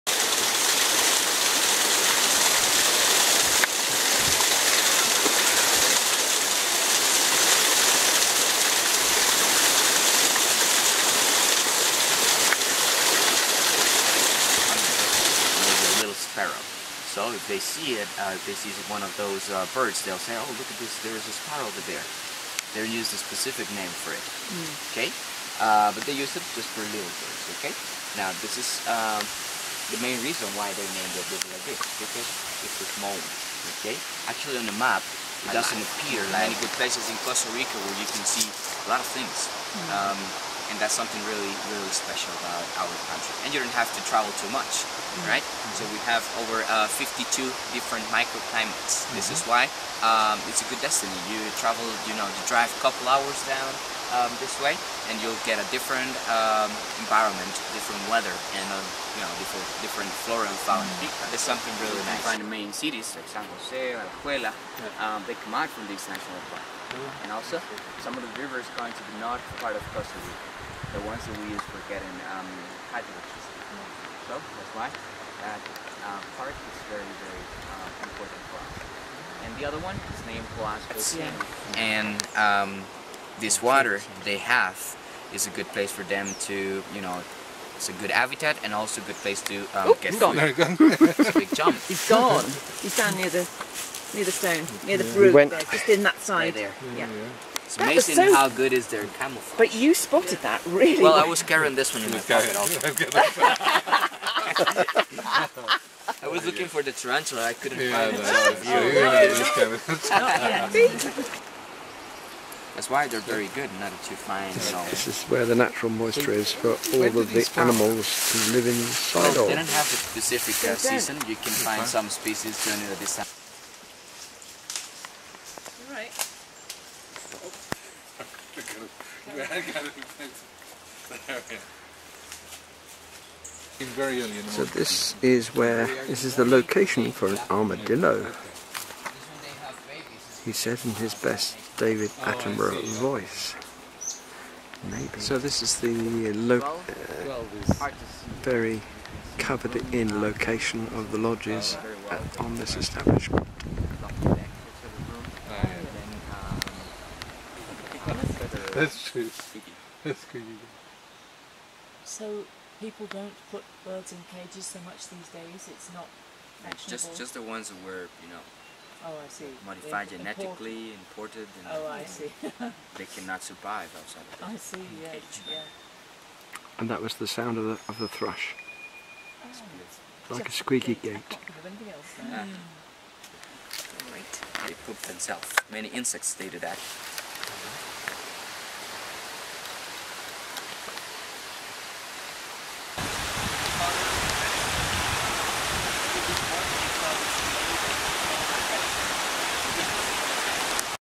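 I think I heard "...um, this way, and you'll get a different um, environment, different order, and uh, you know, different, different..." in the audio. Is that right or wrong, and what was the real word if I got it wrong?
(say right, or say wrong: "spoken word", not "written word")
wrong: "weather", not "order".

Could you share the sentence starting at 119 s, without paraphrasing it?
They don't have a specific uh, season, you can find some species during the summer.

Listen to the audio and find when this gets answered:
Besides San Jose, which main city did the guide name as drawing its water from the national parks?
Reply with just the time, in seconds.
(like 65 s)
63 s.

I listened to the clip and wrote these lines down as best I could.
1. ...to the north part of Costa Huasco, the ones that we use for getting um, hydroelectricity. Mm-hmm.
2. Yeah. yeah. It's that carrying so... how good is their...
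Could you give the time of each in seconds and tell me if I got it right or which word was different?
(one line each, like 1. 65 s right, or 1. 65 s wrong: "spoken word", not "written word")
1. 68 s wrong: "Rica", not "Huasco"
2. 96 s wrong: "amazing", not "carrying".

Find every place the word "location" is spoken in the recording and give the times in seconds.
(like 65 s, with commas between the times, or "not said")
136 s, 150 s.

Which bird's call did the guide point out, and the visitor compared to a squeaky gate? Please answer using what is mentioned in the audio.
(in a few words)
thrush.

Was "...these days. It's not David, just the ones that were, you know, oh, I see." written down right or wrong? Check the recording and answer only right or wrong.
wrong.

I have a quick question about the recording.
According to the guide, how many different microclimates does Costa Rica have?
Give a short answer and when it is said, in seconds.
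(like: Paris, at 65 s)
52, at 46 s.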